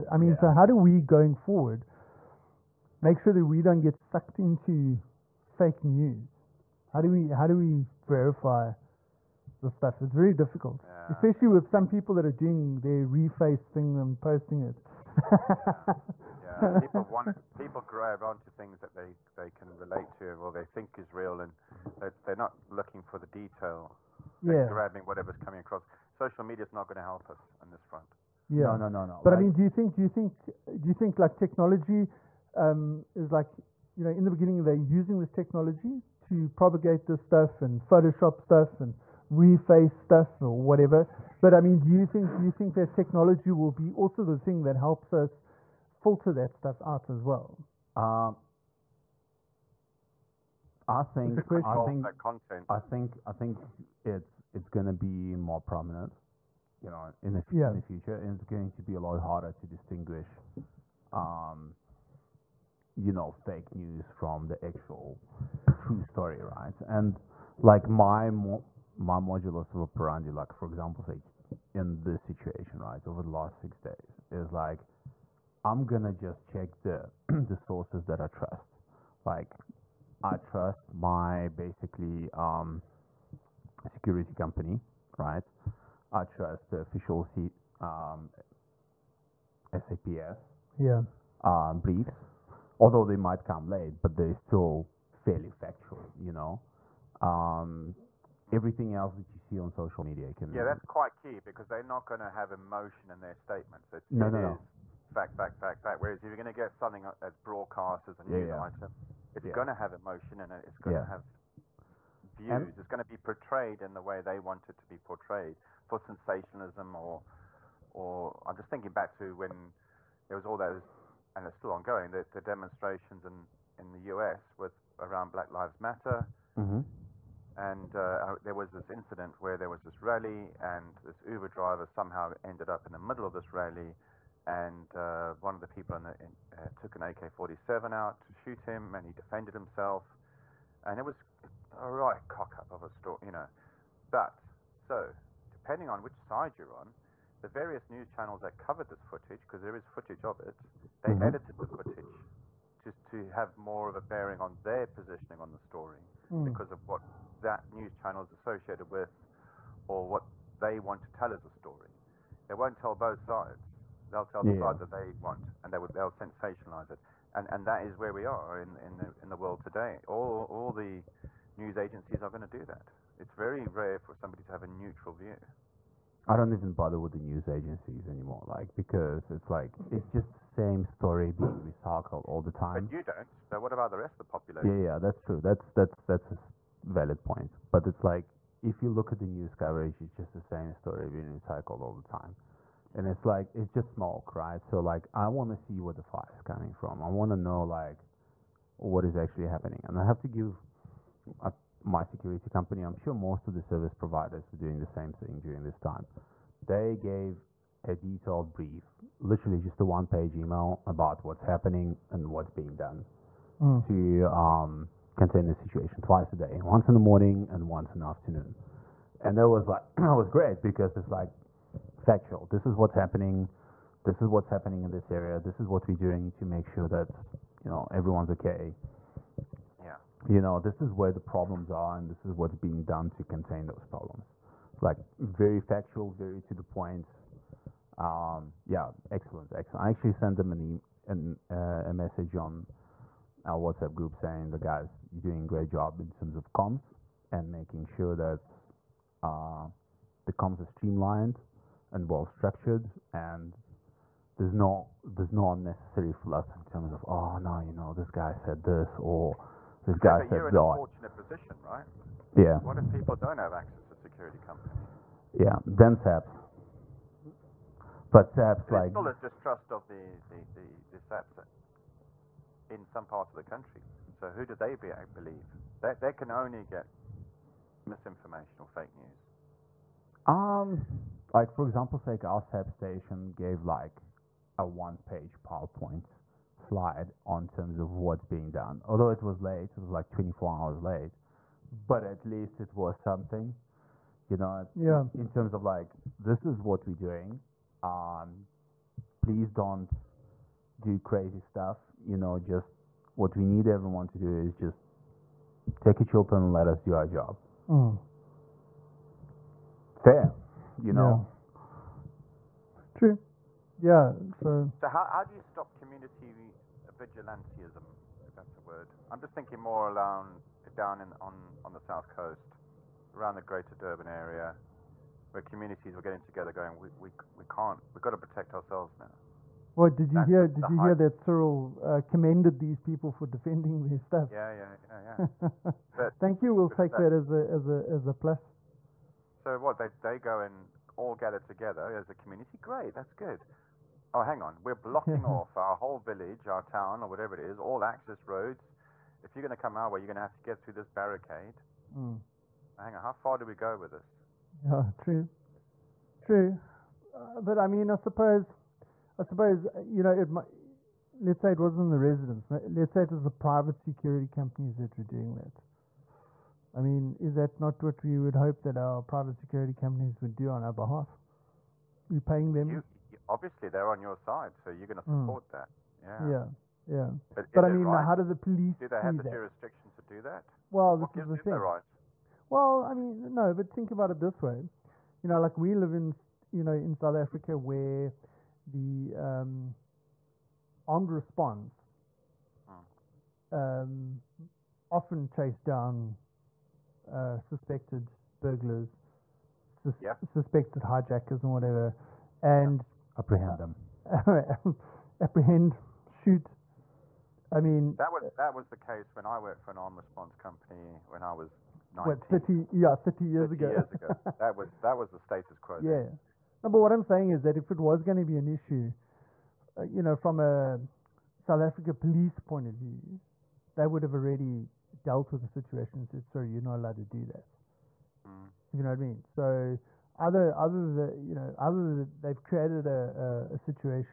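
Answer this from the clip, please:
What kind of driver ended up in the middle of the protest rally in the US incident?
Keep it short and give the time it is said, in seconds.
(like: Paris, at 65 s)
Uber driver, at 131 s.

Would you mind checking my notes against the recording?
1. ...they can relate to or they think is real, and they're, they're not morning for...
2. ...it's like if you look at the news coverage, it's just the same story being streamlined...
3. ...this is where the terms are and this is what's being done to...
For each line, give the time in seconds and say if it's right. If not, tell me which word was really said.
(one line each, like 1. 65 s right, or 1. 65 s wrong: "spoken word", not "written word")
1. 19 s wrong: "looking", not "morning"
2. 187 s wrong: "recycled", not "streamlined"
3. 230 s wrong: "problems", not "terms".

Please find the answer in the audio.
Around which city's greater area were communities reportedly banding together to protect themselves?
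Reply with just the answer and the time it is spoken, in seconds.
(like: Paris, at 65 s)
Durban, at 323 s.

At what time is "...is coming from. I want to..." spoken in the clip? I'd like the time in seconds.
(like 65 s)
196 s.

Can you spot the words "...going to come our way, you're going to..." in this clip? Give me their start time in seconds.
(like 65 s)
349 s.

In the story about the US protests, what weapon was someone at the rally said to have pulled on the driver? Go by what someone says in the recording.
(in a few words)
AK-47.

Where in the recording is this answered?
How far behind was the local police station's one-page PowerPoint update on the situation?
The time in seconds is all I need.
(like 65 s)
290 s.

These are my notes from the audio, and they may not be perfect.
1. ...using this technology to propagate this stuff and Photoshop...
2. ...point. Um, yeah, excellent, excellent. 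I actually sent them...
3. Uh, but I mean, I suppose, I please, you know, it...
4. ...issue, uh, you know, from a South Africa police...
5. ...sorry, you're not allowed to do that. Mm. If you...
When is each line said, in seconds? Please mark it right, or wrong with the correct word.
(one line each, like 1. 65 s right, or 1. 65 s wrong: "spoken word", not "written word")
1. 34 s right
2. 236 s right
3. 357 s wrong: "suppose", not "please"
4. 418 s right
5. 426 s right.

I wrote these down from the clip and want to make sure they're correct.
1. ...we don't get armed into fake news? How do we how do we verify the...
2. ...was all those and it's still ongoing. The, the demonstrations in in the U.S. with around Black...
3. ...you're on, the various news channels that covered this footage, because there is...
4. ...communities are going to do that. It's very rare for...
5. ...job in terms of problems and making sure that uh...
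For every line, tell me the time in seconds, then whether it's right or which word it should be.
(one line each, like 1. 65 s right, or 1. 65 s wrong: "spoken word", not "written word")
1. 3 s wrong: "sucked", not "armed"
2. 120 s right
3. 146 s right
4. 171 s wrong: "agencies", not "communities"
5. 245 s wrong: "comms", not "problems".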